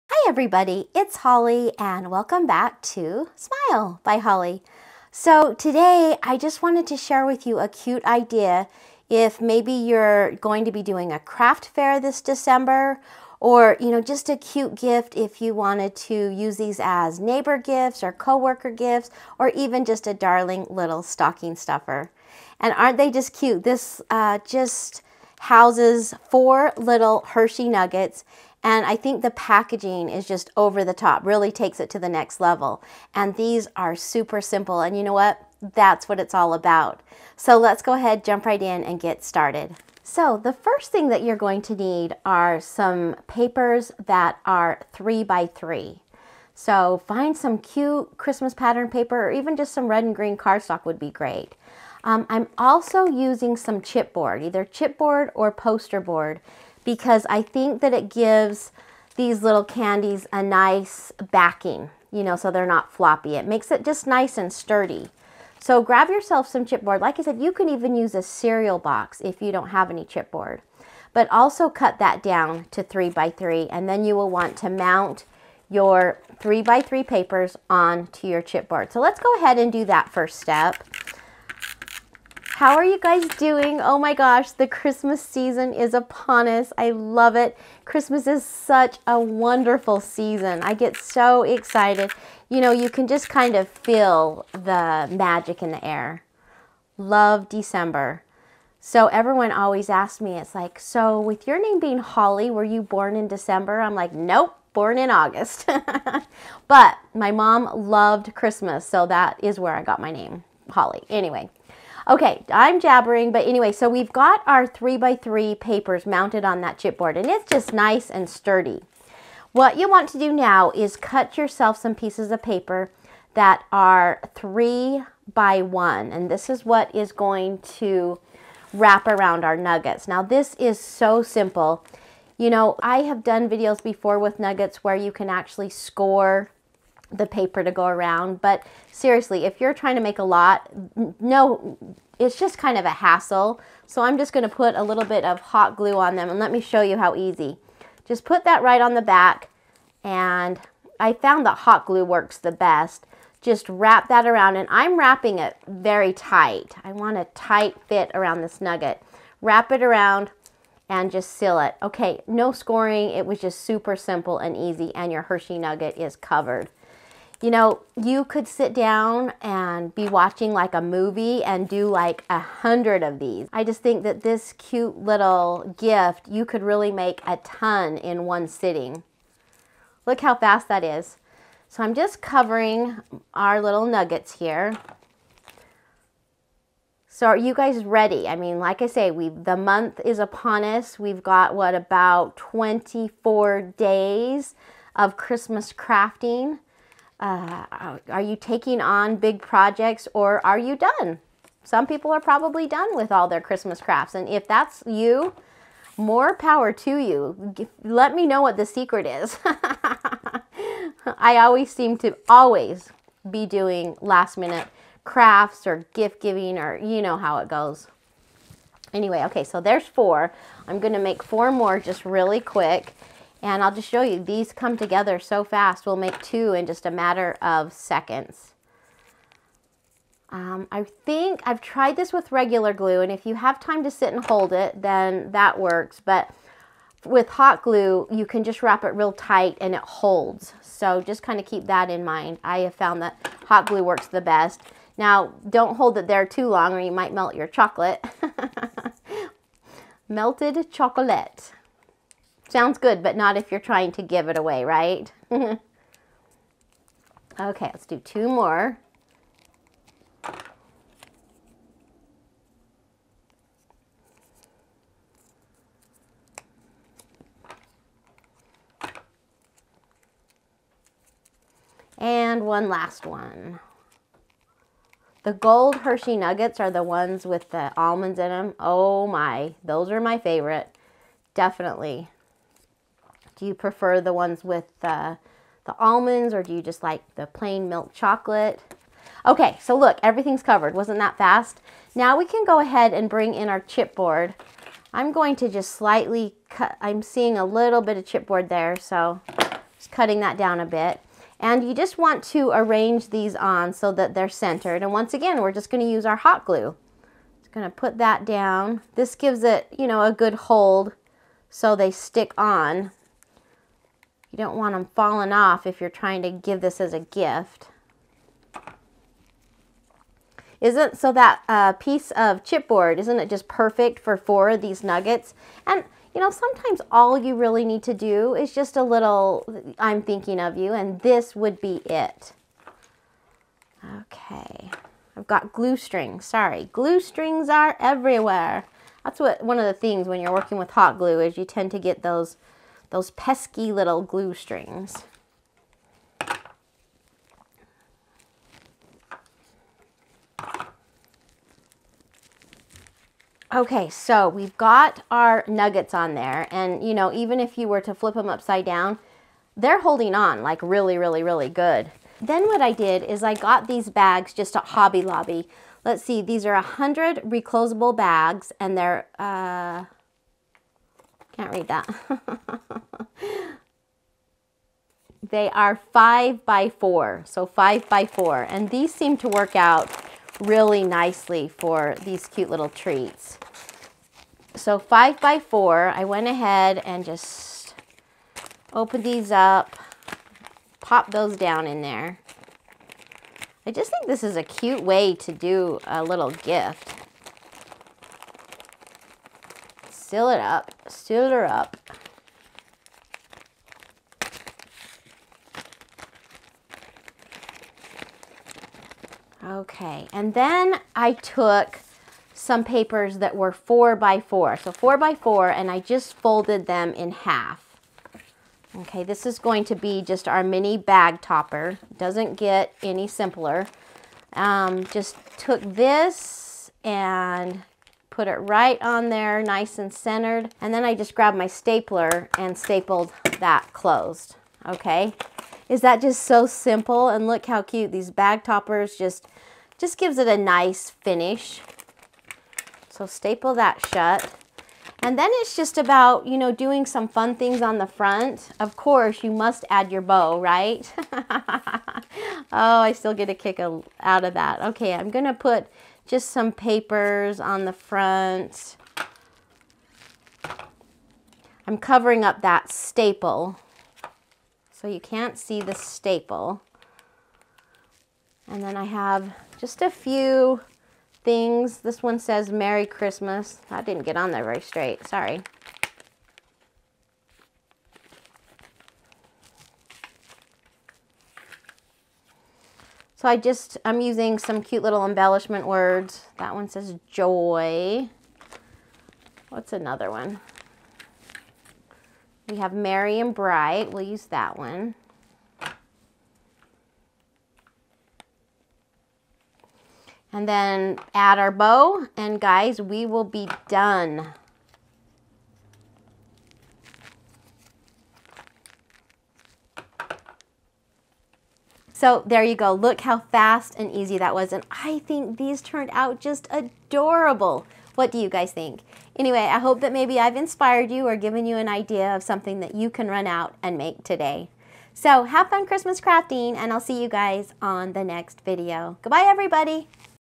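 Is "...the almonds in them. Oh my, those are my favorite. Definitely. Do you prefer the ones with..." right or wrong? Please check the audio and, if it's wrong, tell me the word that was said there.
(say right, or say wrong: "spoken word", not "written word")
right.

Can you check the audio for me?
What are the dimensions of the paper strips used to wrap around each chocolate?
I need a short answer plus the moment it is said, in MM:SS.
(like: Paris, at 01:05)
3 by 1, at 02:04.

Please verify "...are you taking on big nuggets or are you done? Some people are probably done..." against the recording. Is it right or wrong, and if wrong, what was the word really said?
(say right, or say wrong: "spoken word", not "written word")
wrong: "projects", not "nuggets".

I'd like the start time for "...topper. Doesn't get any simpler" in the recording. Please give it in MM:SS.
07:01.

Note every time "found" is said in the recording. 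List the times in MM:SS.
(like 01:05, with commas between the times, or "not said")
02:31, 04:02.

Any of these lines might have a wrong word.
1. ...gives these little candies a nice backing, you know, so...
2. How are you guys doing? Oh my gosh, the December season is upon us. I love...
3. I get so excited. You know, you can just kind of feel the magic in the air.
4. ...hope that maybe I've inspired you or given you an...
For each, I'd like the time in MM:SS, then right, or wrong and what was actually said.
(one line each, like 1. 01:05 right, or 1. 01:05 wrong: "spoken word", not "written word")
1. 00:58 right
2. 01:22 wrong: "Christmas", not "December"
3. 01:30 right
4. 08:39 right.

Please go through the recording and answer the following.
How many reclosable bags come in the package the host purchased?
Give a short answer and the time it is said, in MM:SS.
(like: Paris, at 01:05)
100, at 06:06.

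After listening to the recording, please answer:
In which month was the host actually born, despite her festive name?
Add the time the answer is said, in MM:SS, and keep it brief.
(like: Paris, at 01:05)
August, at 01:45.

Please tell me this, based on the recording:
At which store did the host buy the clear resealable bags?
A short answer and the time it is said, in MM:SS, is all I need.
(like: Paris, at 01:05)
Hobby Lobby, at 06:04.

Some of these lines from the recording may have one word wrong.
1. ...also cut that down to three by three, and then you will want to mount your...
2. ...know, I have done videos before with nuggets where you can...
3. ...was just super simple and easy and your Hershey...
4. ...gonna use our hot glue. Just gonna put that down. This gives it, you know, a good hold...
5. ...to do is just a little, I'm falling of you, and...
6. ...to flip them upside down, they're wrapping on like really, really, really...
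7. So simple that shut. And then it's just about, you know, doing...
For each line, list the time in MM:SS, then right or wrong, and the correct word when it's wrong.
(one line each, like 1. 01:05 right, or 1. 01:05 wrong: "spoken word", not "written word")
1. 01:11 right
2. 02:12 right
3. 02:43 right
4. 05:05 right
5. 05:27 wrong: "thinking", not "falling"
6. 05:57 wrong: "holding", not "wrapping"
7. 07:22 wrong: "staple", not "simple".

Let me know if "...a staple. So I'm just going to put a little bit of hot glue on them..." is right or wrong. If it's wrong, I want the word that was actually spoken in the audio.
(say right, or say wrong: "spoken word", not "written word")
wrong: "hassle", not "staple".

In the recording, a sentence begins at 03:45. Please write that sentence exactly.
We'll make two in just a matter of seconds.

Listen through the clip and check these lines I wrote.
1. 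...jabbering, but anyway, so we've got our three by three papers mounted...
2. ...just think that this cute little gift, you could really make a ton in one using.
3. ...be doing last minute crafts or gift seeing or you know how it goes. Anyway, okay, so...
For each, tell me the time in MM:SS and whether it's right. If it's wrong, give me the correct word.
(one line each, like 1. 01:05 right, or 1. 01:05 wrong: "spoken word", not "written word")
1. 01:52 right
2. 02:53 wrong: "sitting", not "using"
3. 03:33 wrong: "giving", not "seeing".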